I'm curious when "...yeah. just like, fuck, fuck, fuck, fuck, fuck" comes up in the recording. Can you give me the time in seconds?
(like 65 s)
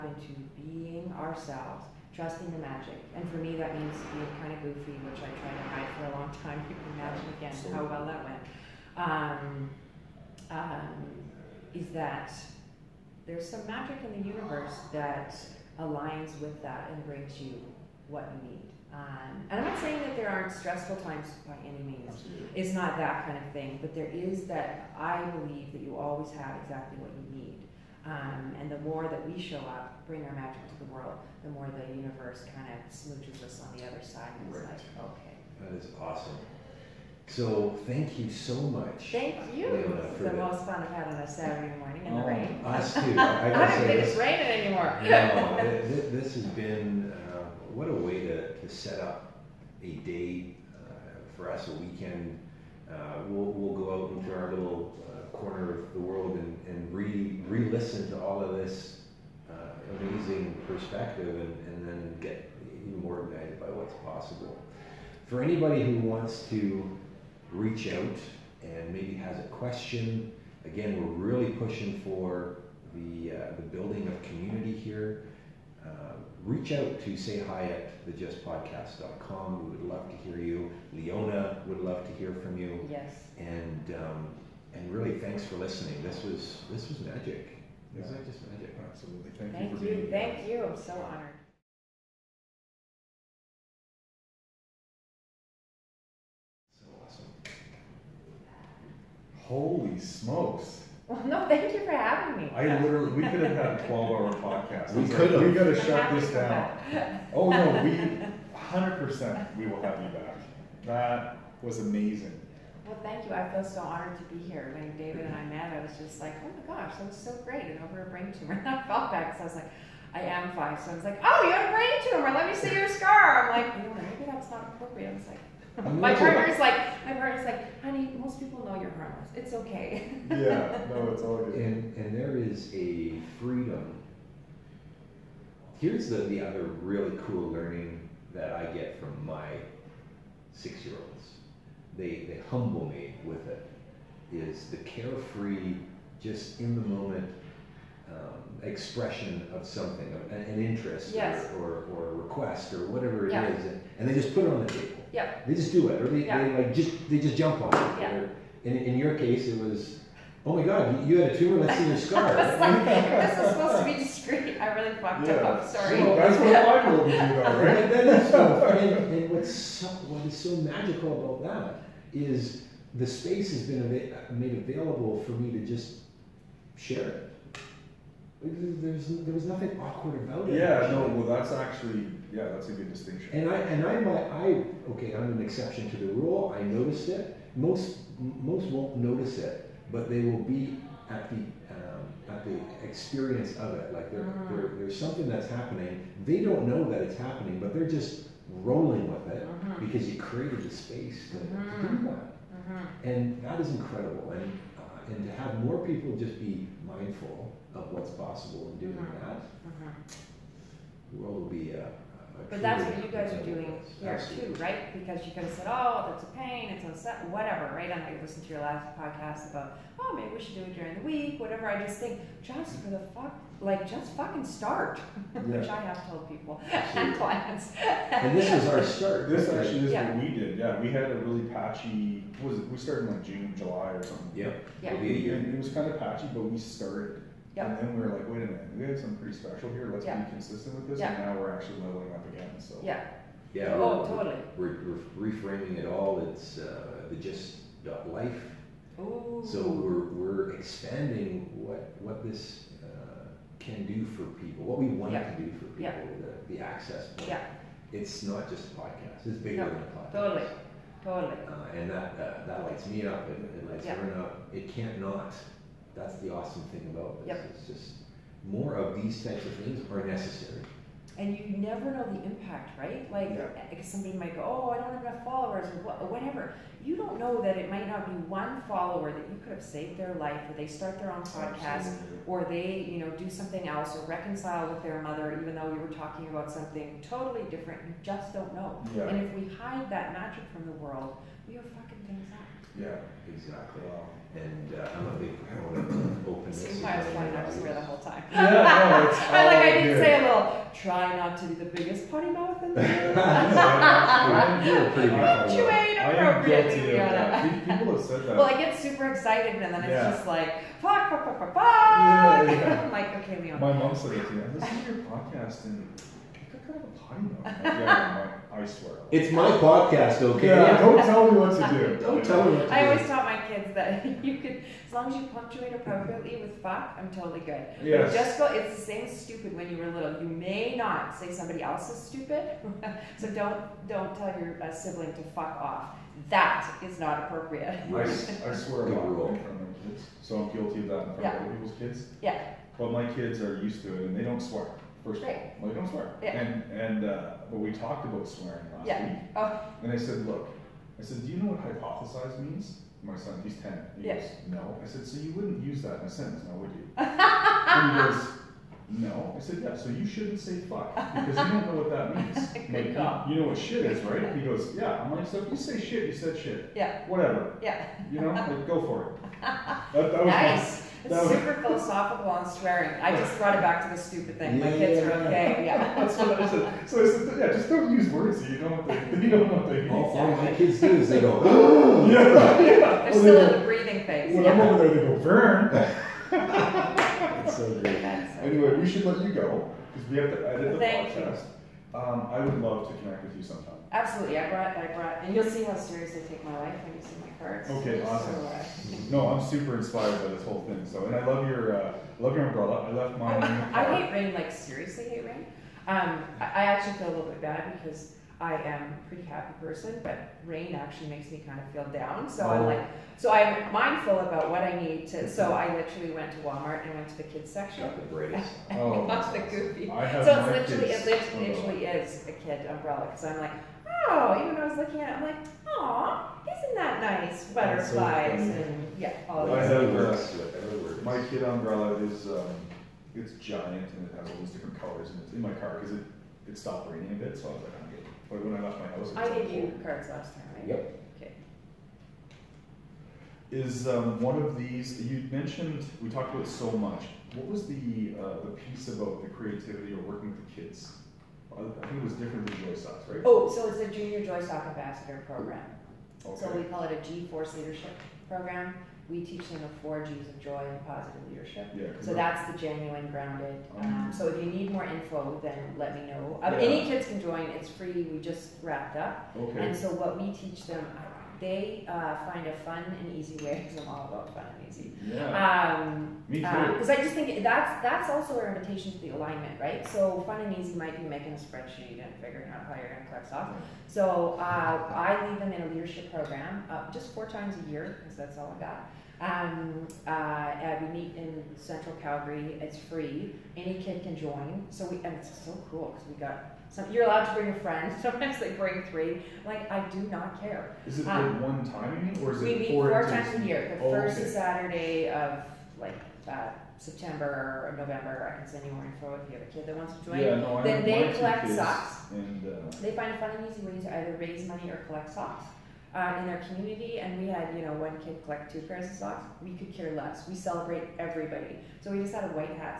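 309 s.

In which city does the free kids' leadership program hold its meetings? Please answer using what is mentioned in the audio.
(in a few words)
Calgary.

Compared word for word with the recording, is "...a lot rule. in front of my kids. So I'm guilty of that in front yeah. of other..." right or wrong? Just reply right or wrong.
right.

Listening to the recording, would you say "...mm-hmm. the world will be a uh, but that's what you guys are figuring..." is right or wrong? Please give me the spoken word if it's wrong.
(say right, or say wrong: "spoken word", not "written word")
wrong: "doing", not "figuring".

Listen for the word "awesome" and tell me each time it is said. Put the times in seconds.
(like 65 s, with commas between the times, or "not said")
36 s, 97 s, 266 s, 398 s.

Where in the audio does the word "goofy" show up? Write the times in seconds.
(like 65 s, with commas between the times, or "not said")
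4 s, 419 s.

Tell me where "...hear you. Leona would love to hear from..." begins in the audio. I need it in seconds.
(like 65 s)
80 s.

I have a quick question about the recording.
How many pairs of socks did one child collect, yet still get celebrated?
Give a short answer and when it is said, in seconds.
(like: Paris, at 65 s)
2, at 518 s.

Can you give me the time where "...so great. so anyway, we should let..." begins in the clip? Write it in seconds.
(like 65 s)
387 s.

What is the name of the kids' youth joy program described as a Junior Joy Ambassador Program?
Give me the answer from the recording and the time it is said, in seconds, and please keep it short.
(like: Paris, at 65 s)
G Force Leadership Program, at 457 s.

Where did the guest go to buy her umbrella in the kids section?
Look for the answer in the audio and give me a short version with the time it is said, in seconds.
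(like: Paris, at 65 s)
Walmart, at 416 s.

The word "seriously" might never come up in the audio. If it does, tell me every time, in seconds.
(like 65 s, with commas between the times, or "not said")
395 s, 404 s.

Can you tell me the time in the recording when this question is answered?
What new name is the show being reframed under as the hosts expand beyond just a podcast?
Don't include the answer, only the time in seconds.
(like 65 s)
247 s.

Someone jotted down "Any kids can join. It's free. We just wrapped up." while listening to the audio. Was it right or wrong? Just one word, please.
right.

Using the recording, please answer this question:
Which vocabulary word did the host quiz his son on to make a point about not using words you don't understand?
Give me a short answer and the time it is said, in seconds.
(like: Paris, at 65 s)
hypothesize, at 351 s.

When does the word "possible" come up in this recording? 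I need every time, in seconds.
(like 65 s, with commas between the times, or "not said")
64 s, 208 s.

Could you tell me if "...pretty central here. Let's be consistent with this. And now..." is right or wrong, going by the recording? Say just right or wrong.
wrong.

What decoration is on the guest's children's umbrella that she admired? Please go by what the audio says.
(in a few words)
Butterflies.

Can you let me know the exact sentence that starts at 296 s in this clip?
I was pointing, I was aware the whole time.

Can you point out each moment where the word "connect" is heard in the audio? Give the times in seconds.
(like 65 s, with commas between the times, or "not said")
393 s.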